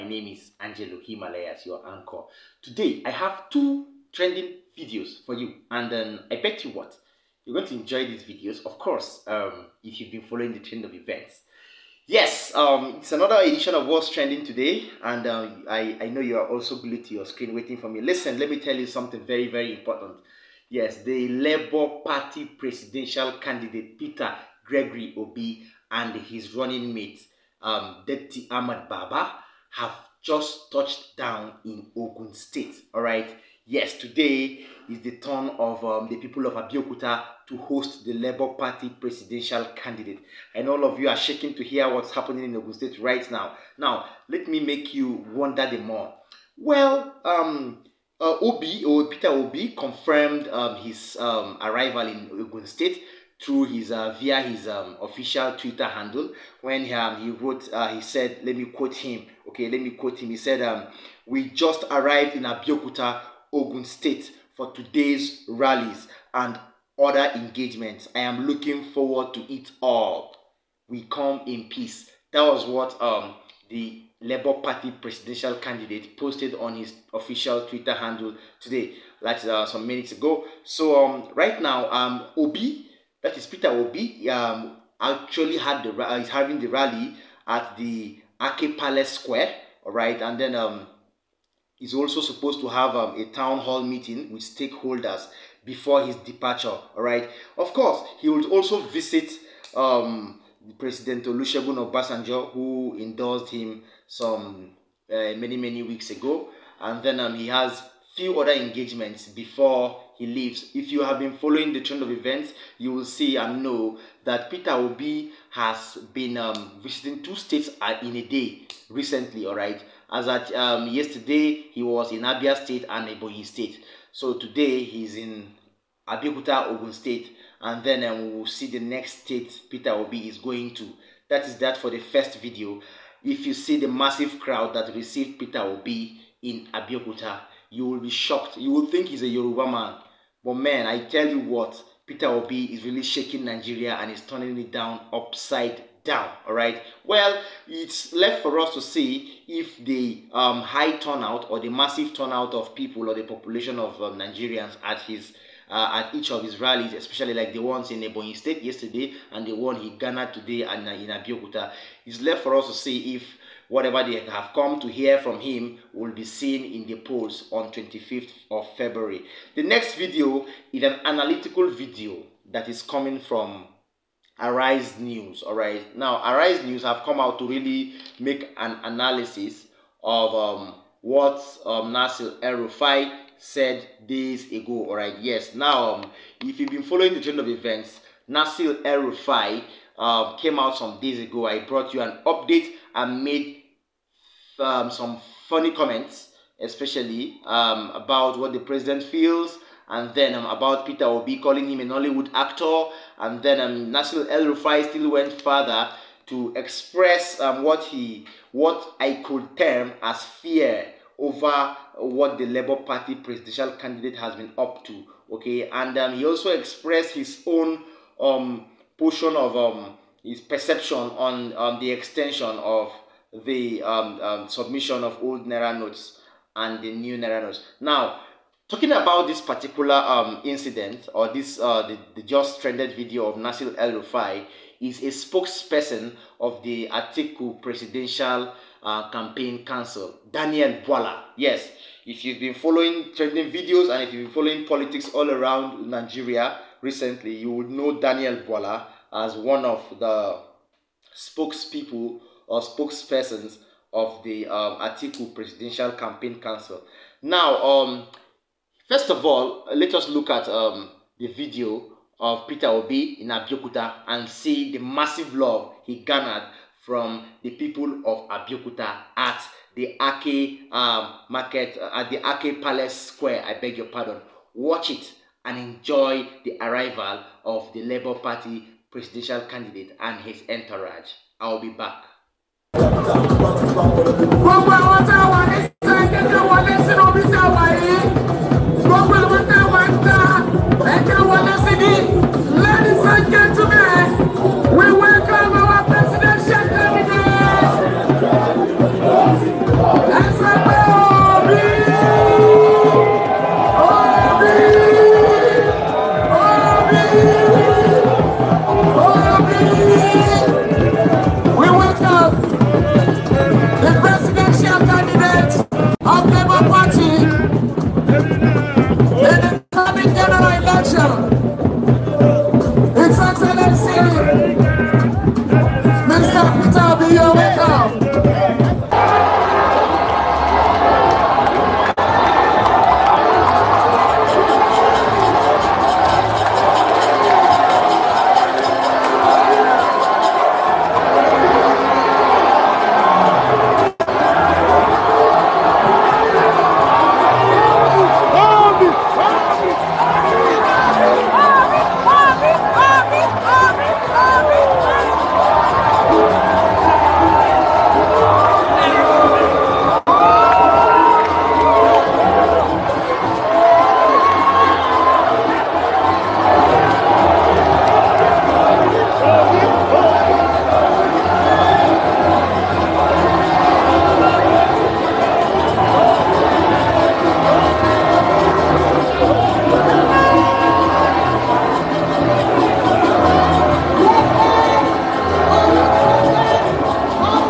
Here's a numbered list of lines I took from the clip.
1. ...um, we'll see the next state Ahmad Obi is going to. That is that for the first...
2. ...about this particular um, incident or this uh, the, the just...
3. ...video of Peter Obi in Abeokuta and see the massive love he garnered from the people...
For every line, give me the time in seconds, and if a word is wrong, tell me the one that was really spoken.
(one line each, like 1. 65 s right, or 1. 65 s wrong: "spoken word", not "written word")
1. 128 s wrong: "Peter", not "Ahmad"
2. 228 s right
3. 261 s right.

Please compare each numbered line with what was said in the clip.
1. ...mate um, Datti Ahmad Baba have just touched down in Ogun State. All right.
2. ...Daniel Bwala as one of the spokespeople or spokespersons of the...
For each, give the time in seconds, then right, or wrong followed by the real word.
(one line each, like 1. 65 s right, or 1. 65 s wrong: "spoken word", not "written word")
1. 26 s right
2. 247 s right.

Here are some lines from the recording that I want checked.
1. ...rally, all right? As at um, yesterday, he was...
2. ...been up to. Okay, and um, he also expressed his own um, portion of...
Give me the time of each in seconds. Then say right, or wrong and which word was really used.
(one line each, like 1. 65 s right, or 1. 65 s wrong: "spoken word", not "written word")
1. 118 s wrong: "recently", not "rally"
2. 214 s right.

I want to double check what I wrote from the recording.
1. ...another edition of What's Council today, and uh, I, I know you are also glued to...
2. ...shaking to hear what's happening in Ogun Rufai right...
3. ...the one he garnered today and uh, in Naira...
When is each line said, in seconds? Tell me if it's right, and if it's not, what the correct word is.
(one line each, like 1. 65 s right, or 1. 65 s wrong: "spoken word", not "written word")
1. 13 s wrong: "Trending", not "Council"
2. 41 s wrong: "State", not "Rufai"
3. 159 s wrong: "Abeokuta", not "Naira".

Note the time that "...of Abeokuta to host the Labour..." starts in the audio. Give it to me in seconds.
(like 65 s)
36 s.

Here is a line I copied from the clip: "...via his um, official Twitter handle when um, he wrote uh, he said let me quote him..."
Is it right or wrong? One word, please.
right.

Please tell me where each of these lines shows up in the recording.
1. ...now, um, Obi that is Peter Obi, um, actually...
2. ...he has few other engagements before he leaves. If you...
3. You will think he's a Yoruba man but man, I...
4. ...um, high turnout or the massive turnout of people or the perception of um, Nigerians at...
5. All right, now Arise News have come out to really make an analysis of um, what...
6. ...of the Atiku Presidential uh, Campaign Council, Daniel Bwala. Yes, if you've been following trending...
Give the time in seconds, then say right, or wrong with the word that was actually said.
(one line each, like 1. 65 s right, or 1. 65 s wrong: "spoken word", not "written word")
1. 81 s right
2. 107 s right
3. 138 s right
4. 150 s wrong: "population", not "perception"
5. 175 s right
6. 236 s right.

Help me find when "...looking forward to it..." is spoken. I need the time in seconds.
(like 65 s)
68 s.